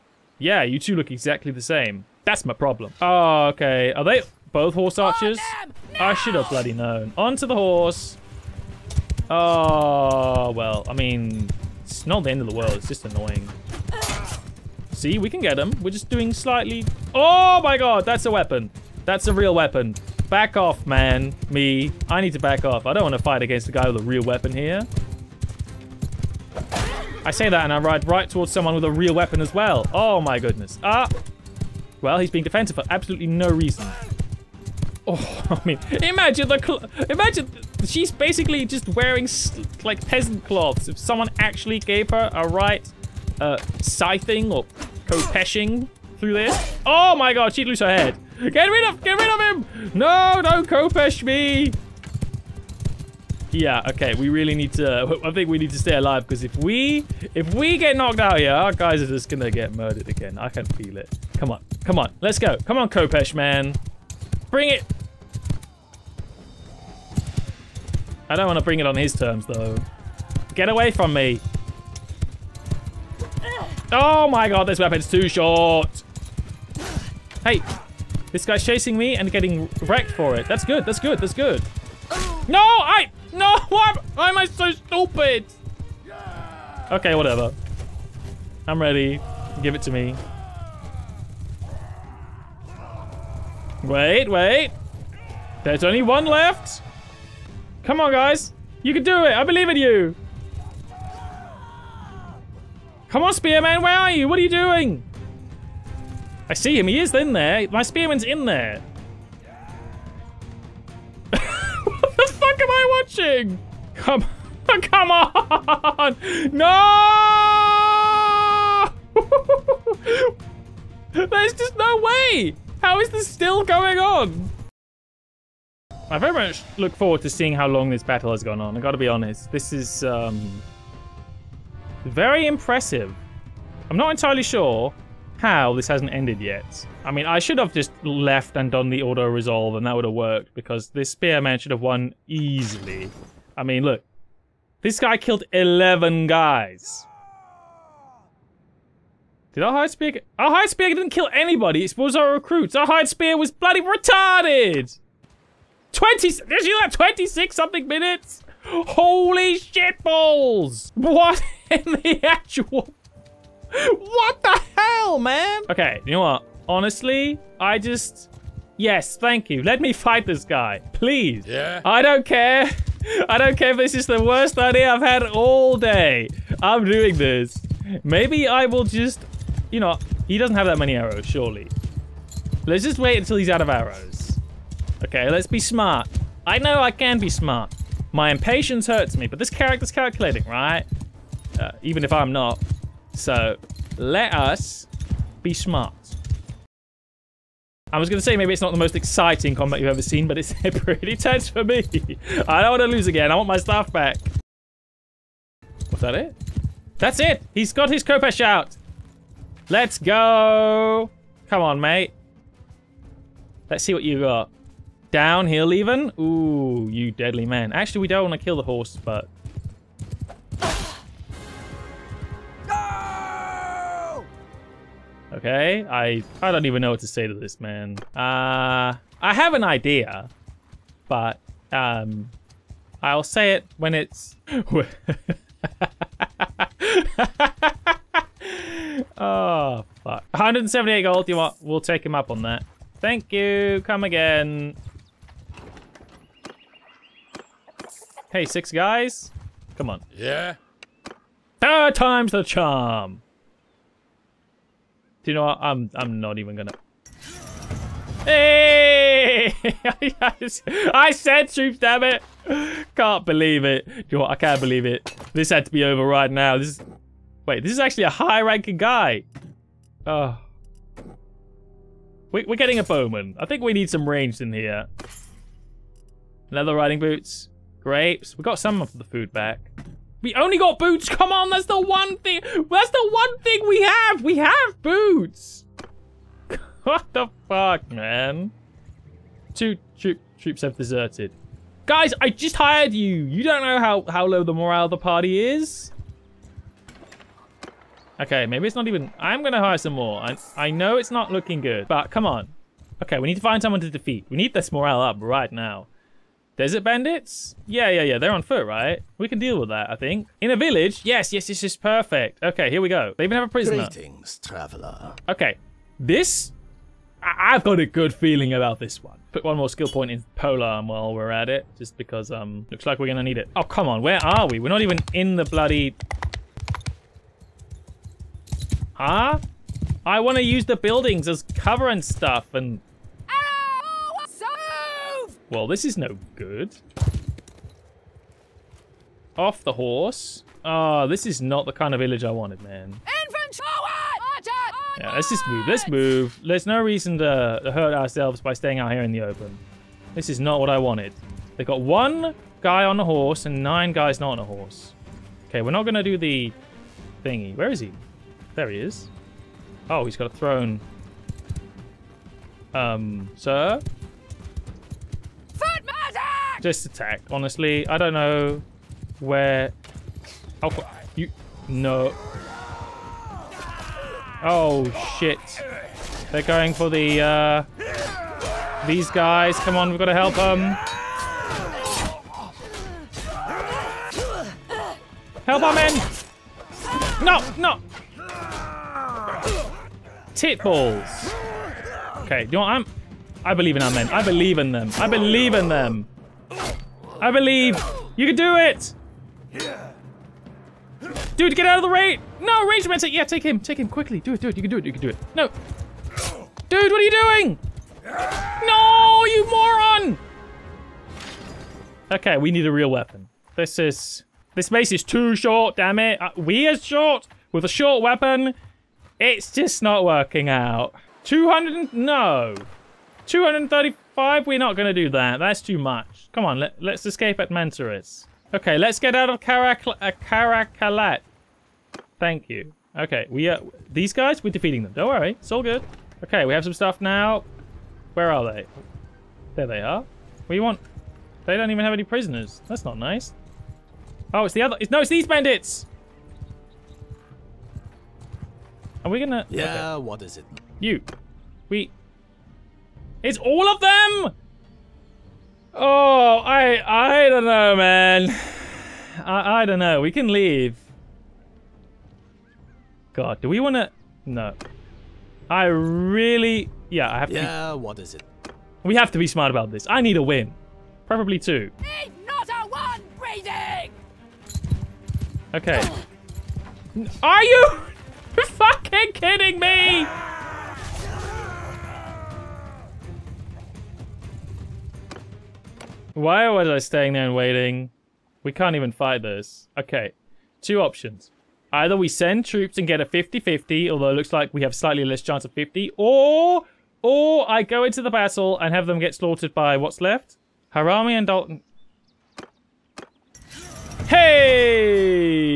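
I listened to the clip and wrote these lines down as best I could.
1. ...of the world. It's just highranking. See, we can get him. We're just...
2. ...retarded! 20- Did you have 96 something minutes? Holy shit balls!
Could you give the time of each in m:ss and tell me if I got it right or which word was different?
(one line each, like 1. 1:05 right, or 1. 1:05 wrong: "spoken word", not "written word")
1. 0:12 wrong: "annoying", not "highranking"
2. 2:33 wrong: "26", not "96".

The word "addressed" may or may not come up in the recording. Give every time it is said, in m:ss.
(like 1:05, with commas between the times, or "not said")
not said.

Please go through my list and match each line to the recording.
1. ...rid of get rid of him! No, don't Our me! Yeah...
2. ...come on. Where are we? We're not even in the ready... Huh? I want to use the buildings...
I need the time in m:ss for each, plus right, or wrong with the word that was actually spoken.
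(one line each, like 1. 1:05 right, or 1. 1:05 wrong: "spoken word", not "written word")
1. 0:48 wrong: "Khopesh", not "Our"
2. 5:23 wrong: "bloody", not "ready".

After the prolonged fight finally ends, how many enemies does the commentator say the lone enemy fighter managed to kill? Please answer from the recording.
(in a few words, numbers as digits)
11.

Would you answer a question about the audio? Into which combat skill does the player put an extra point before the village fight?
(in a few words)
Polearm.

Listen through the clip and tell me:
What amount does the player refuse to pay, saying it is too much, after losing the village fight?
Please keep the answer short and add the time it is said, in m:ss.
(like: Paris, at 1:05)
235, at 7:03.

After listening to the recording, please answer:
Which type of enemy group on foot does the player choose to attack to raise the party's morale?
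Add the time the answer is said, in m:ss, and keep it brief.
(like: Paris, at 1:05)
Desert bandits, at 5:06.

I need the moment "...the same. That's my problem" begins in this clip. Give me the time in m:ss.
0:01.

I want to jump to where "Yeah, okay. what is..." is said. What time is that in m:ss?
7:29.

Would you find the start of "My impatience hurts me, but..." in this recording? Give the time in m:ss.
3:08.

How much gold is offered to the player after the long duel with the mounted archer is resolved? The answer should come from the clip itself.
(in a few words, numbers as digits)
178 gold.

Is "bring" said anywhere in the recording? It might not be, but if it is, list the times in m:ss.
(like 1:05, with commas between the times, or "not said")
1:04, 1:08.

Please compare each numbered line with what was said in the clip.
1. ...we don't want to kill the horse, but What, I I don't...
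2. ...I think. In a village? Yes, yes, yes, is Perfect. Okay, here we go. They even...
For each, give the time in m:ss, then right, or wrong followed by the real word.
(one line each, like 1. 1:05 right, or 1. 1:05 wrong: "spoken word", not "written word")
1. 3:38 wrong: "Okay", not "What"
2. 5:09 right.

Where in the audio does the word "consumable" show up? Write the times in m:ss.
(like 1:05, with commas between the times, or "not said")
not said.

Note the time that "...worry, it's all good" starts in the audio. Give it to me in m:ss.
7:15.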